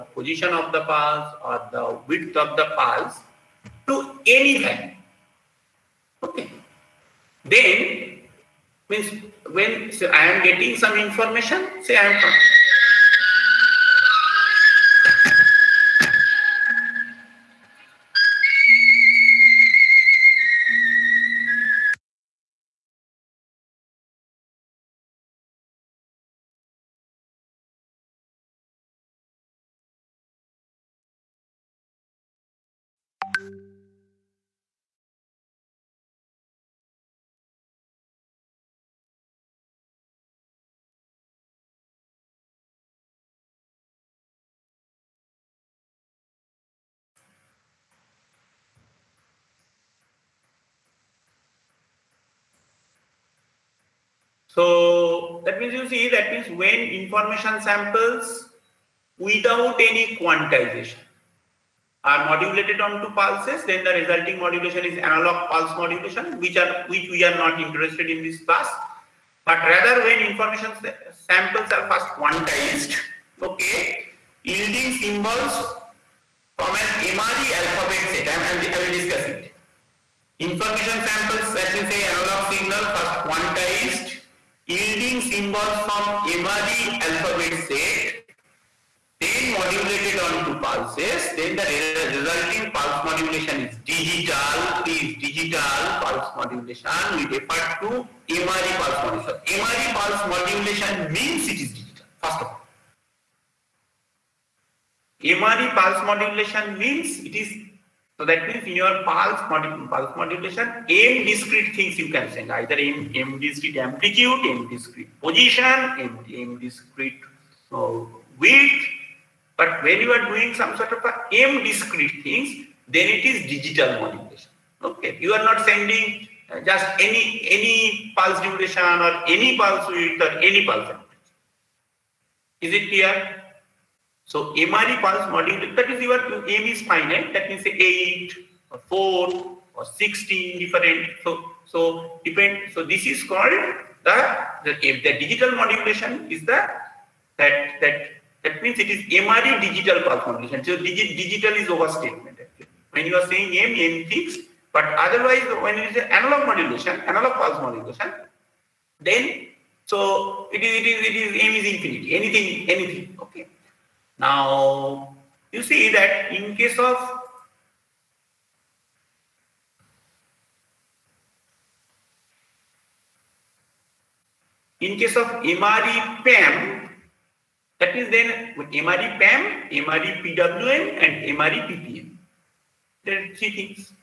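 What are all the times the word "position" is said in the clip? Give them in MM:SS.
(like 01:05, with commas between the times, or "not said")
00:00, 01:55.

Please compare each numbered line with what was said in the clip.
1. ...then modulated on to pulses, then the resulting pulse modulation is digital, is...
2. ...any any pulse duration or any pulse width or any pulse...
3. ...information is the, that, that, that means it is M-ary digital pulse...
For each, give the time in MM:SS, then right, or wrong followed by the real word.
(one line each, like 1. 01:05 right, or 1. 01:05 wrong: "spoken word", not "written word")
1. 01:29 right
2. 02:07 right
3. 02:25 wrong: "modulation", not "information".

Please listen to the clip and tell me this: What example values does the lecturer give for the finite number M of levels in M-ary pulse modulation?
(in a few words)
8, 4 or 16.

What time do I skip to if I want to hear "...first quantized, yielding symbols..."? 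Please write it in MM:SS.
01:22.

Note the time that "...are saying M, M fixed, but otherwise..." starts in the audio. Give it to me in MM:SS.
02:33.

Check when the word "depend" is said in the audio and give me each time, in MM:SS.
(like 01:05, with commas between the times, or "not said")
02:22.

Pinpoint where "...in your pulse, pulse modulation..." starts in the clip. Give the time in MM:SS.
01:48.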